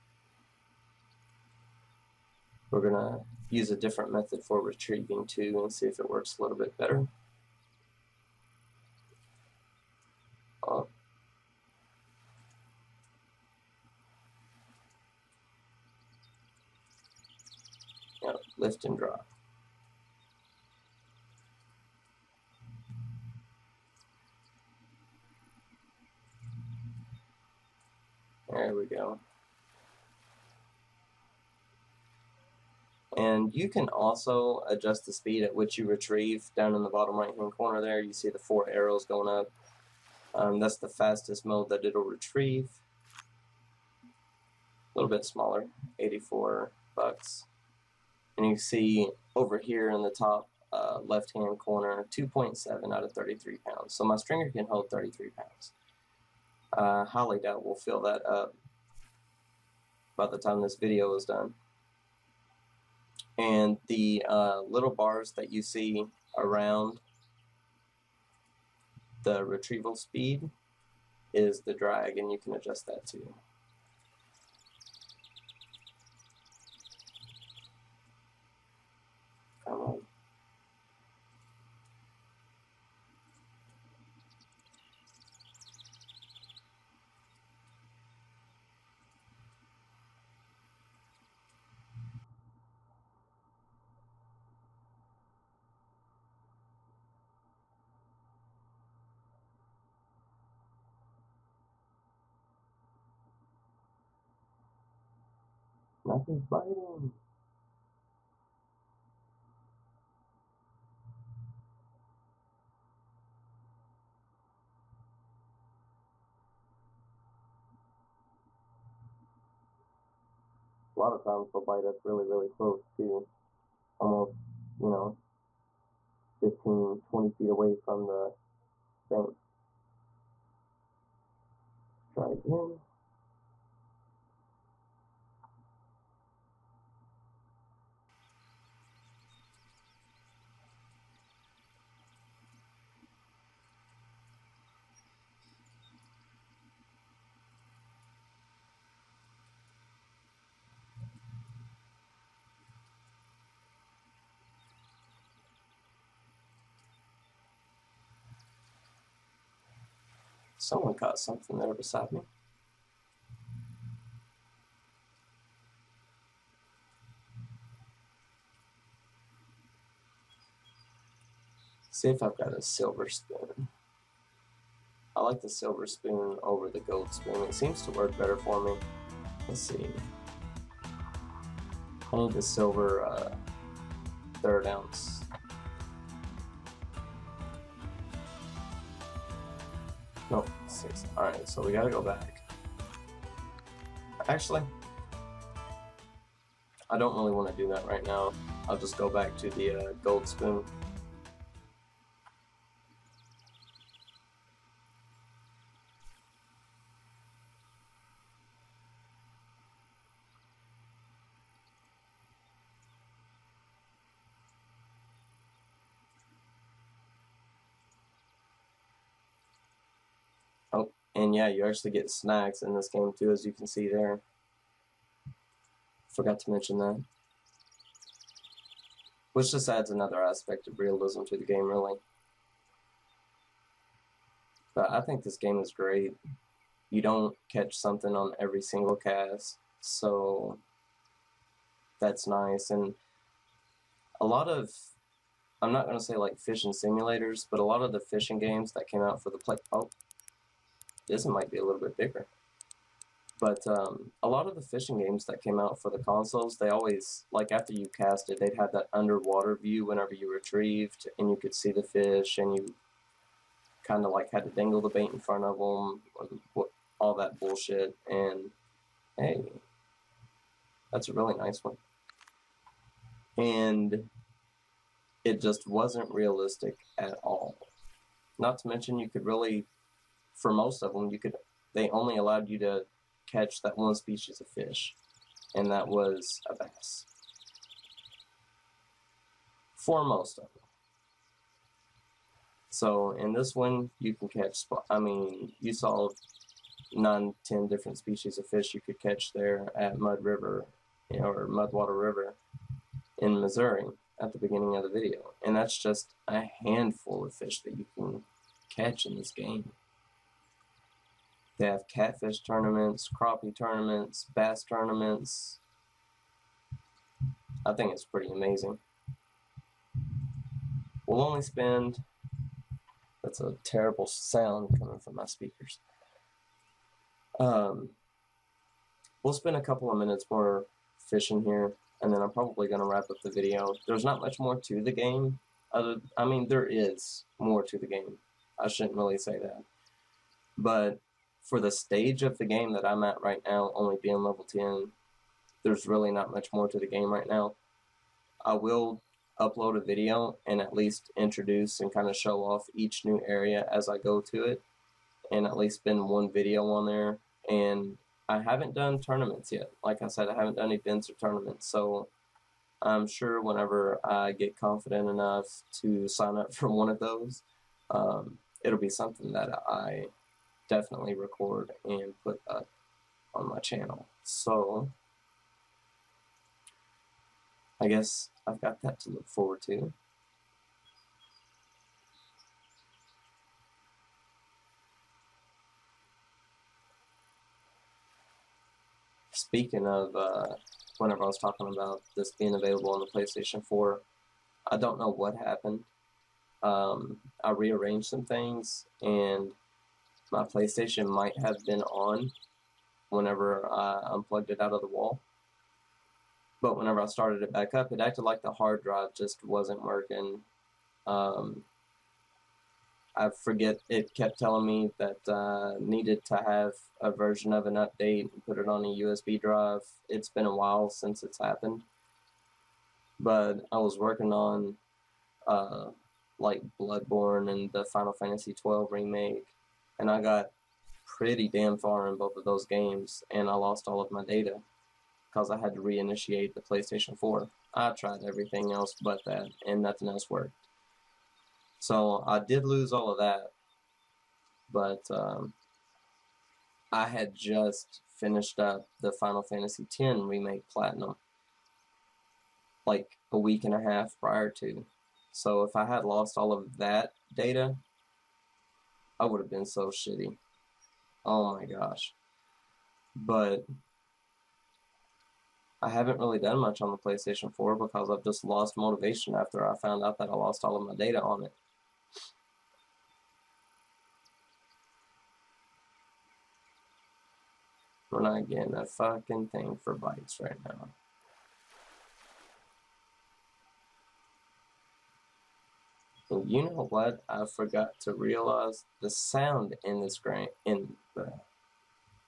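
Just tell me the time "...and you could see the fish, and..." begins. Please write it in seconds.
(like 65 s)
261 s.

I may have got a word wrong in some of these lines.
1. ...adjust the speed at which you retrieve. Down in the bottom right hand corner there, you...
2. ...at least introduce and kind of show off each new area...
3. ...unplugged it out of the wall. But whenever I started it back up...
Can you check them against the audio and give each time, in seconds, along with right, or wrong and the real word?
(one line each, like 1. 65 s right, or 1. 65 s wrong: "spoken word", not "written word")
1. 34 s right
2. 350 s right
3. 404 s right.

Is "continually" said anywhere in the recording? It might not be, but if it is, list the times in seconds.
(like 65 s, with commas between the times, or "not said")
not said.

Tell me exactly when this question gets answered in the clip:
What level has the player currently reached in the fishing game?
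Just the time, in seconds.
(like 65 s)
344 s.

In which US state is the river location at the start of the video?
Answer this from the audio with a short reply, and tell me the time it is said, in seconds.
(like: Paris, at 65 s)
Missouri, at 303 s.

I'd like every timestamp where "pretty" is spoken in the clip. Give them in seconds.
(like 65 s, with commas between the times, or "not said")
318 s, 431 s.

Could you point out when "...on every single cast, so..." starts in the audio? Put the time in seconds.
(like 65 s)
238 s.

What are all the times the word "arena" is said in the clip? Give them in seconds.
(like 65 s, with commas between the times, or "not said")
not said.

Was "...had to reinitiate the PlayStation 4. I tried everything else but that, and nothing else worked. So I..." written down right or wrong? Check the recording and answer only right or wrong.
right.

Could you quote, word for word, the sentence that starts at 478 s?
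We're not getting a fucking thing for bites right now.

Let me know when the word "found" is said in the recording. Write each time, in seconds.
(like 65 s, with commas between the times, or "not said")
469 s.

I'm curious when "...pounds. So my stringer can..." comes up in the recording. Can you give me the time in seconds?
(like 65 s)
53 s.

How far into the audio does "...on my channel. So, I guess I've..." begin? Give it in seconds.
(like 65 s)
373 s.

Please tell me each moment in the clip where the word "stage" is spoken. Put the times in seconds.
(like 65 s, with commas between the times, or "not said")
341 s.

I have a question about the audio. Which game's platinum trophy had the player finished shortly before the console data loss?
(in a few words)
Final Fantasy X Remake.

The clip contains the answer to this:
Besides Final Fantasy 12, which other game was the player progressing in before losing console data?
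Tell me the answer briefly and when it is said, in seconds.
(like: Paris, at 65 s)
Bloodborne, at 426 s.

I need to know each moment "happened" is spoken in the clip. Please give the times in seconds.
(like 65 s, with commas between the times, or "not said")
395 s, 421 s.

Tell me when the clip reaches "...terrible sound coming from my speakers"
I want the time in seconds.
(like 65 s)
323 s.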